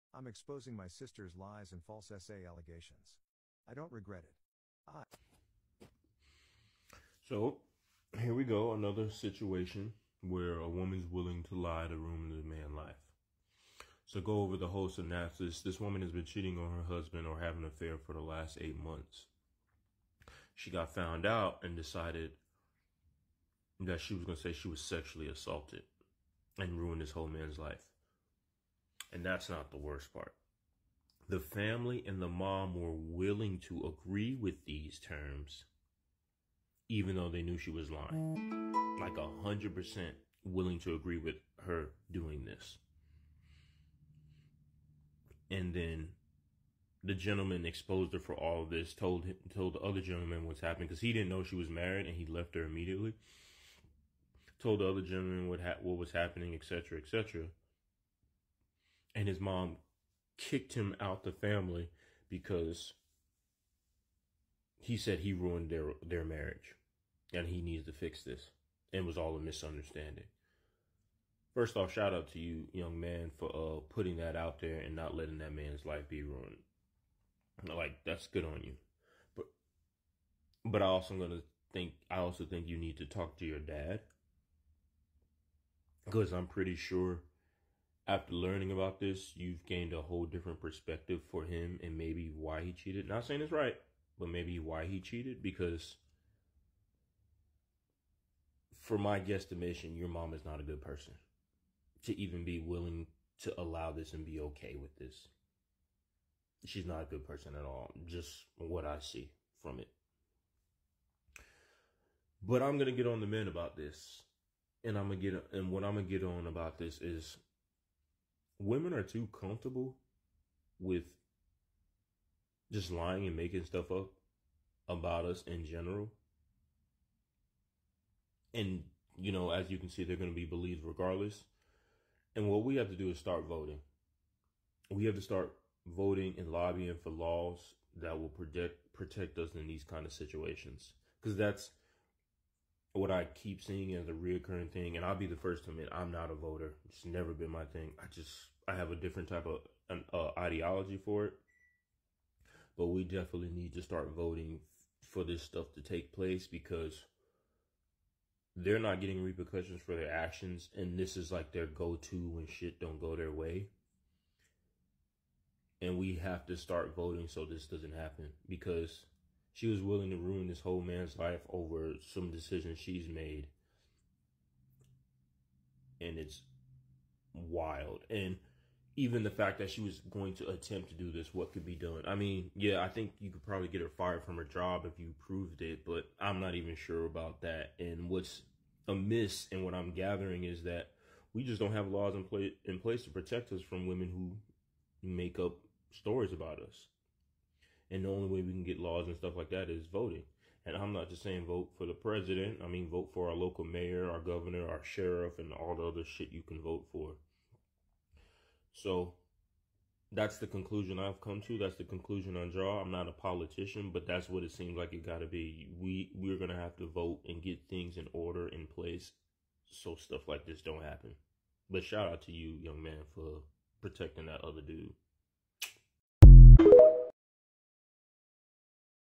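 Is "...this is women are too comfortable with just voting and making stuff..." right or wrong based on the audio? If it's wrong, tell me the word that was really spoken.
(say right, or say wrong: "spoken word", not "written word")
wrong: "lying", not "voting".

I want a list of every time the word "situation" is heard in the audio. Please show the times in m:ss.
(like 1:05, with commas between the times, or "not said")
0:09, 2:20.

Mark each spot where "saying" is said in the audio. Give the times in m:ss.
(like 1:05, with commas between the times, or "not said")
1:33, 3:21.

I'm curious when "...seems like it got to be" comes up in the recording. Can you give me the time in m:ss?
3:34.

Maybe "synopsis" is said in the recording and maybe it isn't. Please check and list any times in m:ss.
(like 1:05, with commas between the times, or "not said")
0:14.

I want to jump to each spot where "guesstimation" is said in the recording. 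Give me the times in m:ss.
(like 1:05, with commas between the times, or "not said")
1:39.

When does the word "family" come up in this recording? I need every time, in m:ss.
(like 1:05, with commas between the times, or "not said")
0:31, 1:01.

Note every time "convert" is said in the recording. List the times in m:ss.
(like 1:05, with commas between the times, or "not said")
not said.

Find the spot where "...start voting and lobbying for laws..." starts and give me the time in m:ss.
2:15.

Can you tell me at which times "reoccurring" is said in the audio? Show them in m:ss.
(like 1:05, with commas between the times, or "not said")
2:24.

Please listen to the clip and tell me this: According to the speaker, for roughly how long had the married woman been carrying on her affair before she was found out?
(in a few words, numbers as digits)
8 months.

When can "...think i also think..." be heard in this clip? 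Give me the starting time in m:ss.
1:21.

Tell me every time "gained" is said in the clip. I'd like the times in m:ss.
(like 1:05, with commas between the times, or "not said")
1:29.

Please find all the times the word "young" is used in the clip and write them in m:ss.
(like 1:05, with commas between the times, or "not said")
1:12, 3:42.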